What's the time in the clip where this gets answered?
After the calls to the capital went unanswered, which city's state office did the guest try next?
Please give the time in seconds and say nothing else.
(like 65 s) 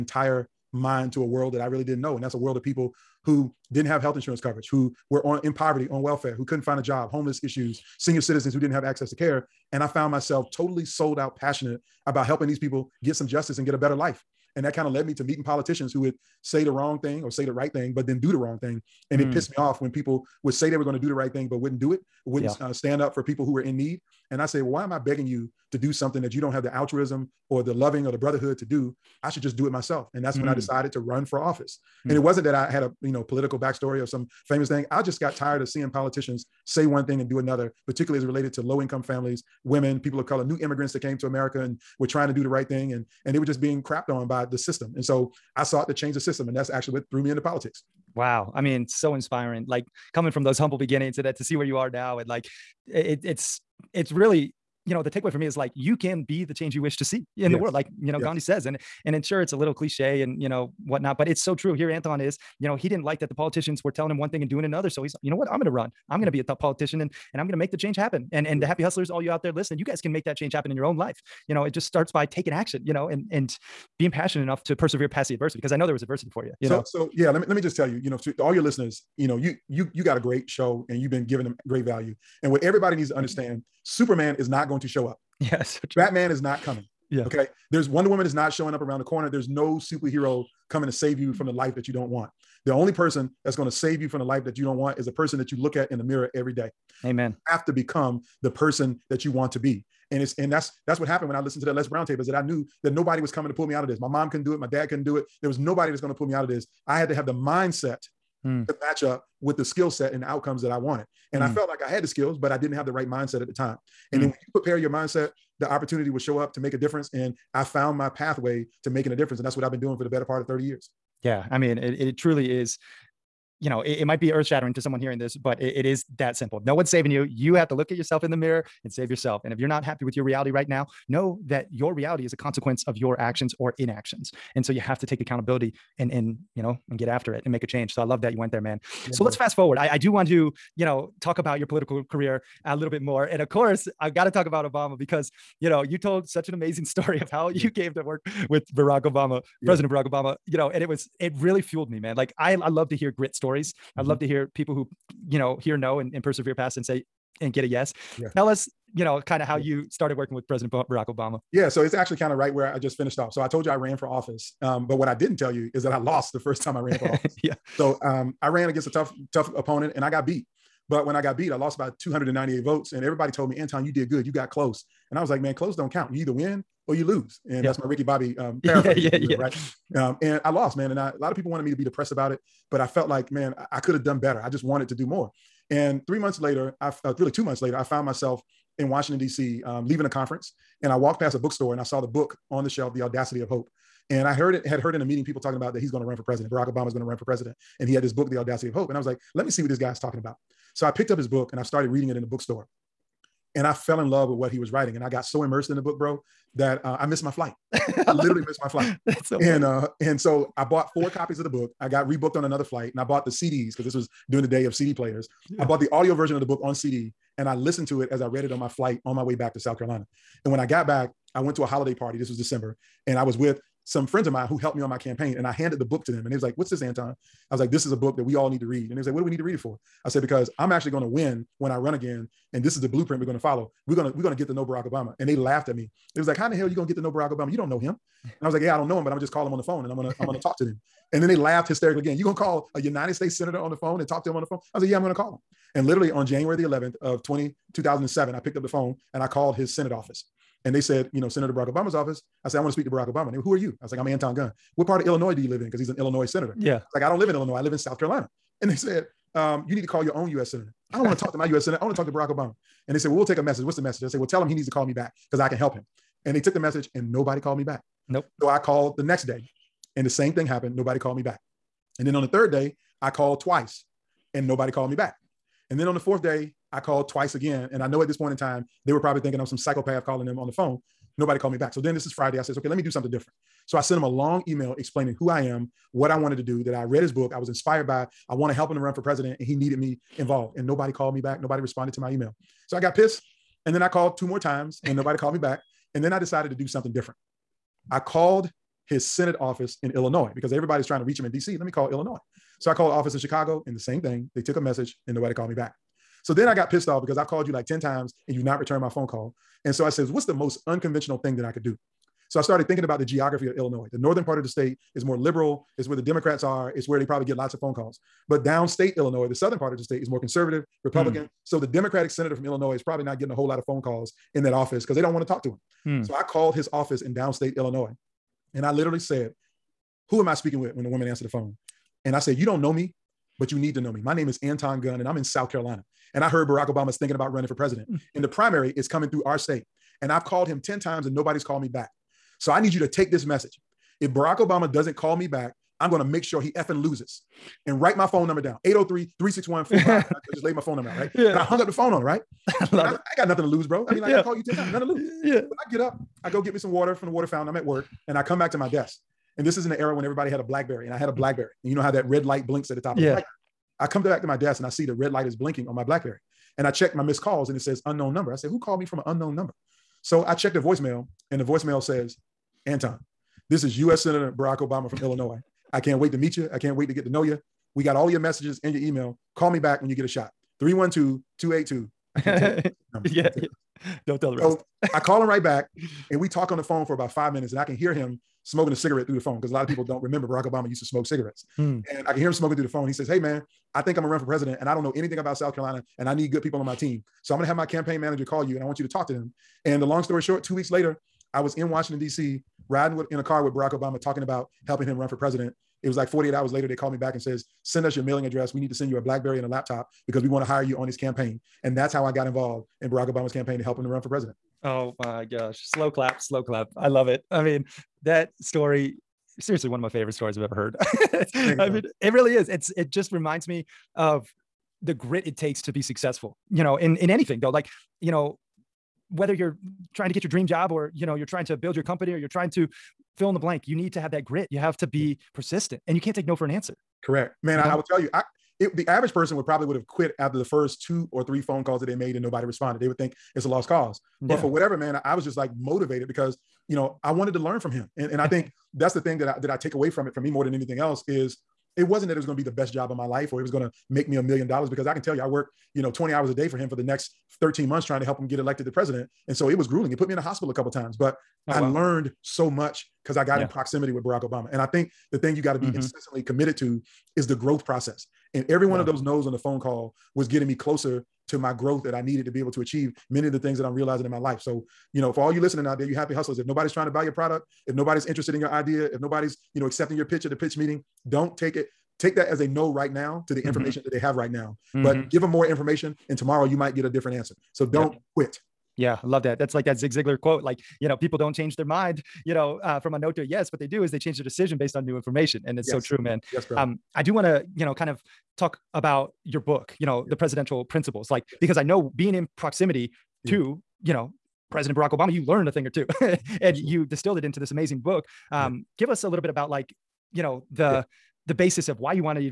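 303 s.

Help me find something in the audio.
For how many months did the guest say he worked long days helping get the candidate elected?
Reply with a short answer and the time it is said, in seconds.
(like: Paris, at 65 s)
13, at 457 s.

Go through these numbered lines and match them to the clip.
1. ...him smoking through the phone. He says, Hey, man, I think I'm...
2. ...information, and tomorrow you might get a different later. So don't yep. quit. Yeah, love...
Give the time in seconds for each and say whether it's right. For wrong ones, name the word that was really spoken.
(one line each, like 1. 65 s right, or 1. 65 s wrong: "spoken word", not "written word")
1. 392 s right
2. 485 s wrong: "answer", not "later".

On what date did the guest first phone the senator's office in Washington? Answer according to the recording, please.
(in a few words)
January 11, 2007.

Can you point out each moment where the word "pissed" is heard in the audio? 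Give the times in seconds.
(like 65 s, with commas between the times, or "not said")
19 s, 292 s, 306 s.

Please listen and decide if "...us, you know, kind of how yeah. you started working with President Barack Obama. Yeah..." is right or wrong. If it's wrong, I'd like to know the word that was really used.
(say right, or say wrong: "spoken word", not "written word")
right.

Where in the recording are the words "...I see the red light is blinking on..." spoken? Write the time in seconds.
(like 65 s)
364 s.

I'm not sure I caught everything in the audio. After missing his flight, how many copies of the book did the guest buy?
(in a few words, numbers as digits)
4.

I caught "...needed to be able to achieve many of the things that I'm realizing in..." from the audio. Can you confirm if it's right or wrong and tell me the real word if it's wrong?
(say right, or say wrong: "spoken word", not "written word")
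right.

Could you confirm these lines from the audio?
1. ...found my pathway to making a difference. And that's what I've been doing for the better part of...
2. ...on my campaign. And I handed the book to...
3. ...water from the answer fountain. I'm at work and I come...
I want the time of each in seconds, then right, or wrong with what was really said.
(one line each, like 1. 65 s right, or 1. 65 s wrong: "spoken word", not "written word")
1. 117 s right
2. 224 s right
3. 356 s wrong: "water", not "answer".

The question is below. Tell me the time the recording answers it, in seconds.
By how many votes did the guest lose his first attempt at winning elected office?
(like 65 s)
172 s.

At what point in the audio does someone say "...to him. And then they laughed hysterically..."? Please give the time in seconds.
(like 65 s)
240 s.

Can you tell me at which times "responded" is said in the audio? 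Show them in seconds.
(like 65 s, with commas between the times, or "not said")
291 s, 442 s.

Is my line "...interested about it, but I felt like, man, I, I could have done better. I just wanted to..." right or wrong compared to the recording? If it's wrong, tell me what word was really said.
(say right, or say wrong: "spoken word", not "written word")
wrong: "depressed", not "interested".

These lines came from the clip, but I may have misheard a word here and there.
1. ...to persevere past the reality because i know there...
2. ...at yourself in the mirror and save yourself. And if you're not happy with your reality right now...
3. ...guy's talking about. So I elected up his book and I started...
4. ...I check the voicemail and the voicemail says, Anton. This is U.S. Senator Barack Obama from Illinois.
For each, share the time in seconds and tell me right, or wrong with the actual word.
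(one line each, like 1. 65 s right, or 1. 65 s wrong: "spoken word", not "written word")
1. 74 s wrong: "adversity", not "reality"
2. 127 s right
3. 199 s wrong: "picked", not "elected"
4. 370 s right.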